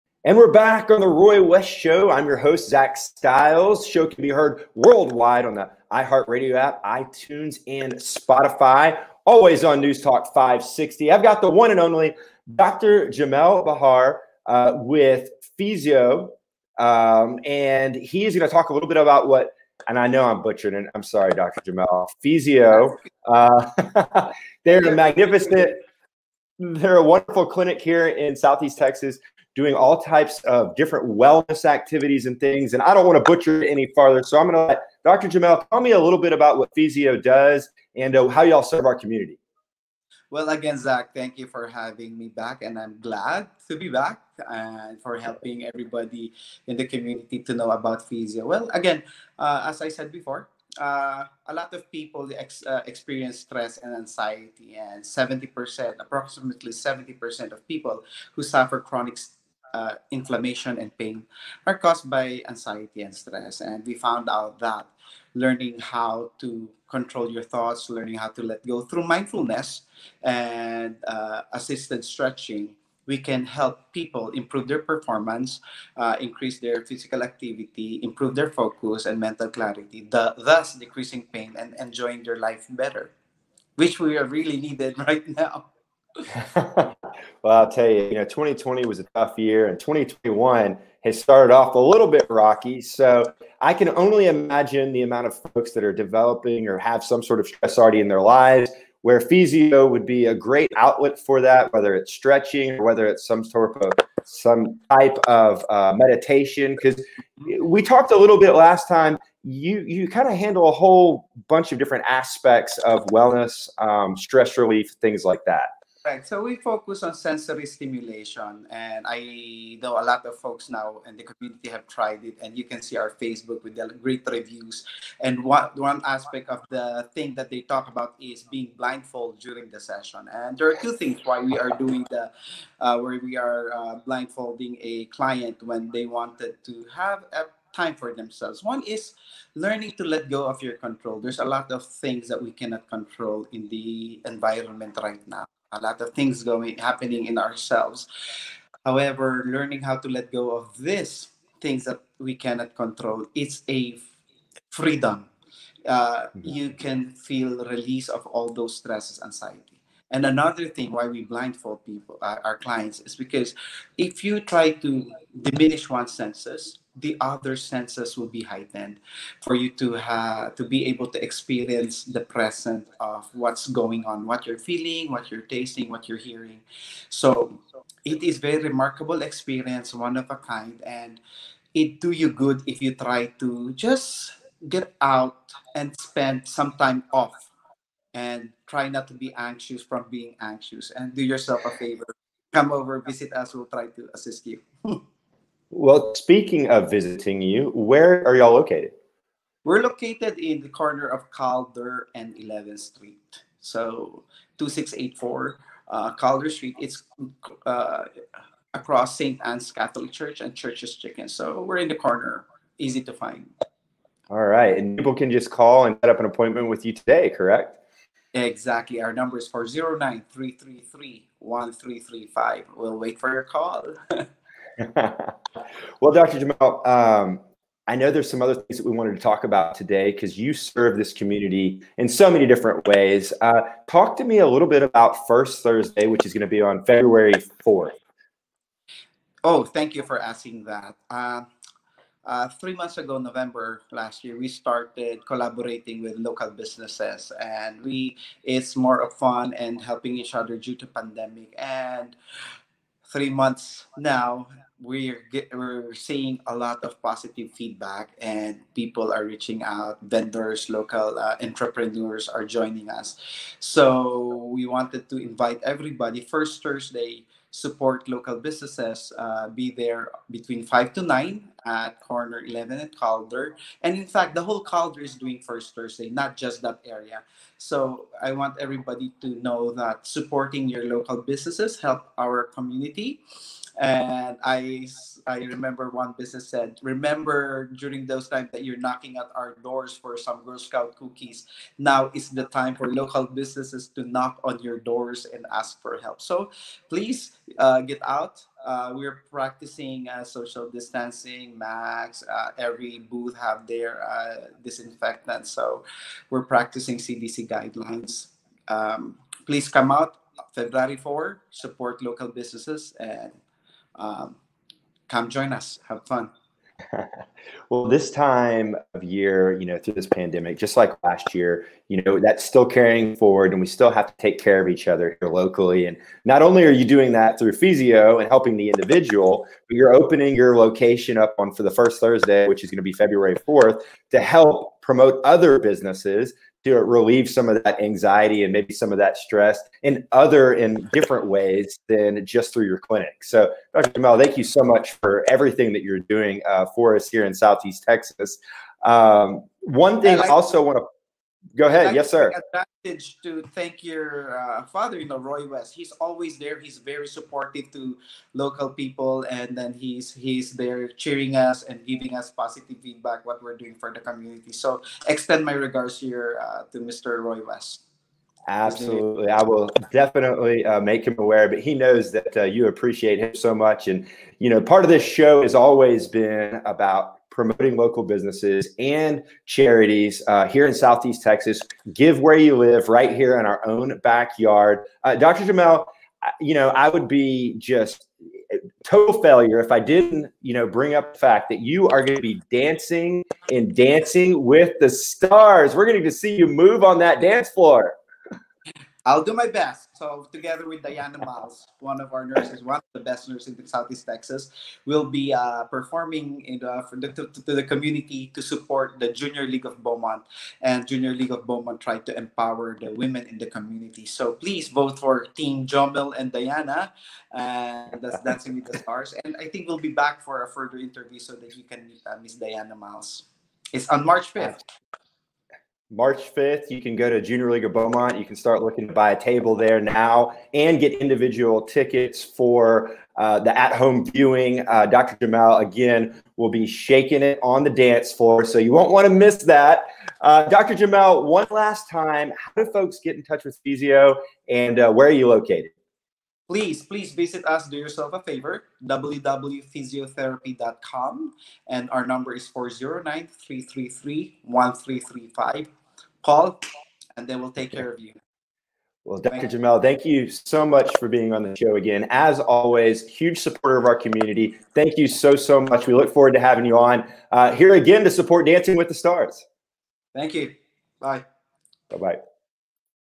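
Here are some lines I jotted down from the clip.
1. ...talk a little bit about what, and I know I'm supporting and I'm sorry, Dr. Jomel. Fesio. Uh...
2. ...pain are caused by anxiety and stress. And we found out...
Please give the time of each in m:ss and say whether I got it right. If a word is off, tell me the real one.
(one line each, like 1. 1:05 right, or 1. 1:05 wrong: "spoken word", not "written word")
1. 0:18 wrong: "butchering", not "supporting"
2. 1:00 right.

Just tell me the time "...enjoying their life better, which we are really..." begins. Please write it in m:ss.
1:21.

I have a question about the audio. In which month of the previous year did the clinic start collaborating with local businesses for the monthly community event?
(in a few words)
November.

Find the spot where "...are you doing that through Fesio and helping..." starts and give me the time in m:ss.
5:26.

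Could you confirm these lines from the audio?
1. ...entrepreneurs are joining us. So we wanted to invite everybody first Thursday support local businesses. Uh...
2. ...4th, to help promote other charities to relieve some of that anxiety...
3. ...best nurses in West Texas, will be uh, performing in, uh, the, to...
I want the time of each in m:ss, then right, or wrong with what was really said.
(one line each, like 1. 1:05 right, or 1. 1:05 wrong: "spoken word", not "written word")
1. 4:21 right
2. 5:33 wrong: "businesses", not "charities"
3. 6:42 wrong: "Southeast", not "West".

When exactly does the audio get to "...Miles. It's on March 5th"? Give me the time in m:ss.
7:02.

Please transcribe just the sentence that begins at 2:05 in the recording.
And one one aspect of the thing that they talk about is being blindfolded during the session.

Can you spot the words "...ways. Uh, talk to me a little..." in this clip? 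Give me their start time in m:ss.
3:52.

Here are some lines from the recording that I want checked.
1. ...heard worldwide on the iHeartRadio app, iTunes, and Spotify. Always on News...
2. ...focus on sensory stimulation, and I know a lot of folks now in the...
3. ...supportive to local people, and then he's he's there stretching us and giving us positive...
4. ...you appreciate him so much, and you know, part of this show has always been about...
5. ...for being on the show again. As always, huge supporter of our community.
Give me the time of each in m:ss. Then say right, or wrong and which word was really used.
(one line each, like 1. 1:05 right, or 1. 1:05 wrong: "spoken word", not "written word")
1. 0:04 right
2. 1:56 right
3. 5:57 wrong: "cheering", not "stretching"
4. 6:12 right
5. 7:40 right.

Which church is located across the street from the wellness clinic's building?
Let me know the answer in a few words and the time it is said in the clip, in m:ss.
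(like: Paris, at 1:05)
St. Anne's Catholic Church, at 3:29.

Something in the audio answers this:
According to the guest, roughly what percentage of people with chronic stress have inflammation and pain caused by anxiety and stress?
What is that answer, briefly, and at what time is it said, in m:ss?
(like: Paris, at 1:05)
70%, at 0:55.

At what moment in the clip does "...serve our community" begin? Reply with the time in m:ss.
0:38.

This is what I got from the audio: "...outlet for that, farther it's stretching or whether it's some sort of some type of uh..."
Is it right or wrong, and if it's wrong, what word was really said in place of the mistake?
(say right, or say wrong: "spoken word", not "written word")
wrong: "whether", not "farther".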